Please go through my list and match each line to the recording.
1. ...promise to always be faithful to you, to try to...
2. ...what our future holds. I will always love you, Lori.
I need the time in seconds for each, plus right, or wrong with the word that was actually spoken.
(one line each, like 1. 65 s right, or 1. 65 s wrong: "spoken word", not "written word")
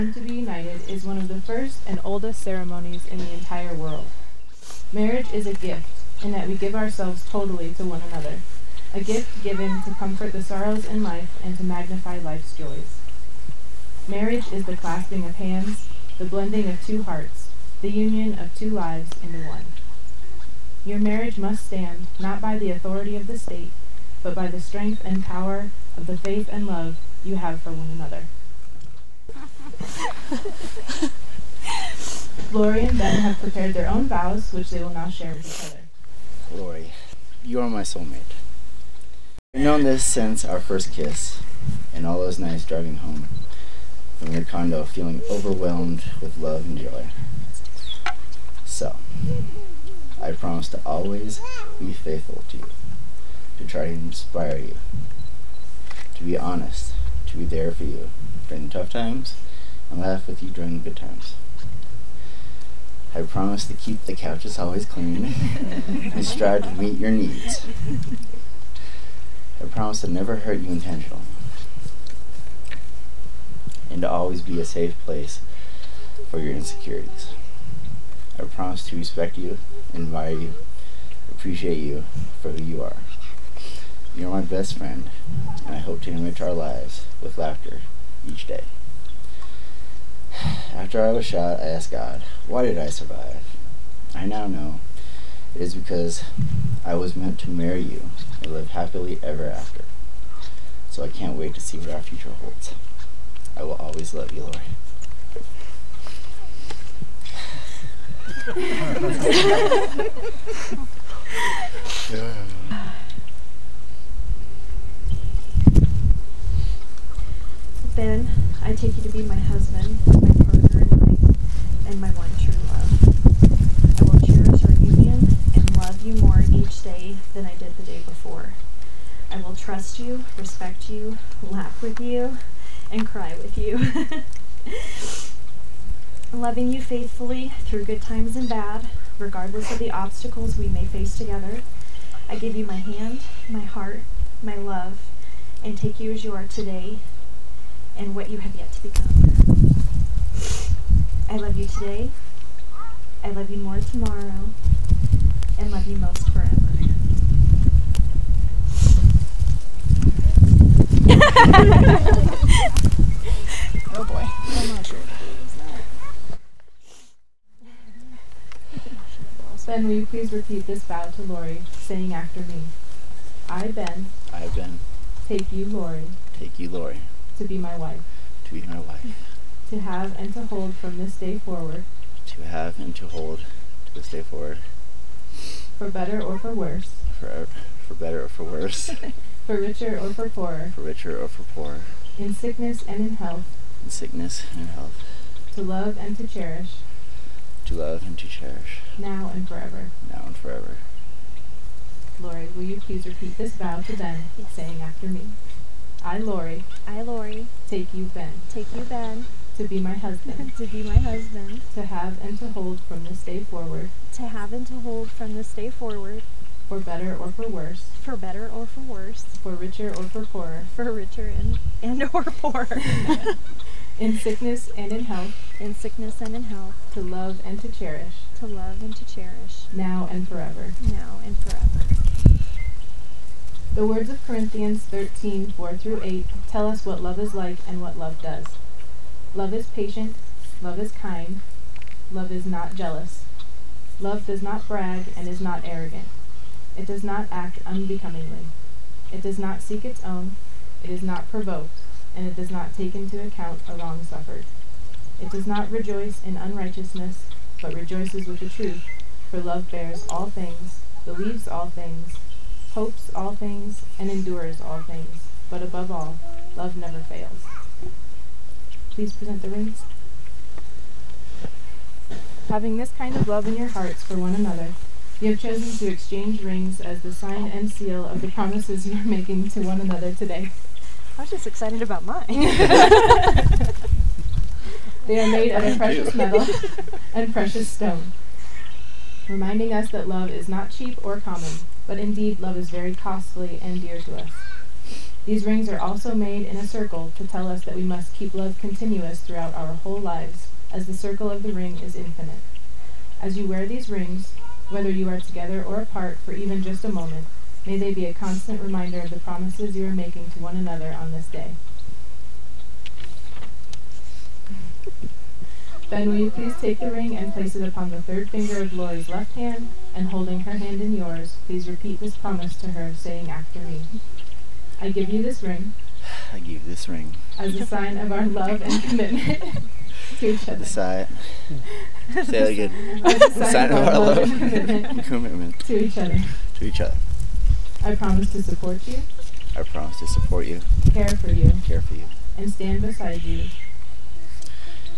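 1. 50 s right
2. 101 s right.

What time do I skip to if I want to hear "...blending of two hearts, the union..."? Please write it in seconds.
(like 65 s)
16 s.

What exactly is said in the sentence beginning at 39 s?
I've known this since our first kiss, and all those nights driving home from your condo feeling overwhelmed with love and joy.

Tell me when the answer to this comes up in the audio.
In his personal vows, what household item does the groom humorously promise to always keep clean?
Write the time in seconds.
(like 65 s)
64 s.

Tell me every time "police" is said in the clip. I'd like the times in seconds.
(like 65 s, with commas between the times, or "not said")
not said.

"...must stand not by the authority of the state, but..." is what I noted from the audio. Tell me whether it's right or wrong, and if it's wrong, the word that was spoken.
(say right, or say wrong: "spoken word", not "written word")
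right.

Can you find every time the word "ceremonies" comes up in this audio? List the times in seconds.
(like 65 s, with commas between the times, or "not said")
2 s.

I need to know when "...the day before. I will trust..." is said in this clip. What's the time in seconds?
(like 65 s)
127 s.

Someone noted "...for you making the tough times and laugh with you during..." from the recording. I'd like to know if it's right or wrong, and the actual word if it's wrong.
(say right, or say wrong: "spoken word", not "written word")
wrong: "during", not "making".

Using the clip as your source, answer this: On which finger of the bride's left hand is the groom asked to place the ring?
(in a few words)
Third finger.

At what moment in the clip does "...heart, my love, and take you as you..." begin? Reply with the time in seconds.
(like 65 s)
143 s.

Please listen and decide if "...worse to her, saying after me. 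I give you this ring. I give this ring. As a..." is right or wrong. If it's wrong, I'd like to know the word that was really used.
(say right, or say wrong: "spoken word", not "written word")
wrong: "promise", not "worse".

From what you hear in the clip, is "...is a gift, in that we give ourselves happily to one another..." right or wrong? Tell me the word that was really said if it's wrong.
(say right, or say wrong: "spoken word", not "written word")
wrong: "totally", not "happily".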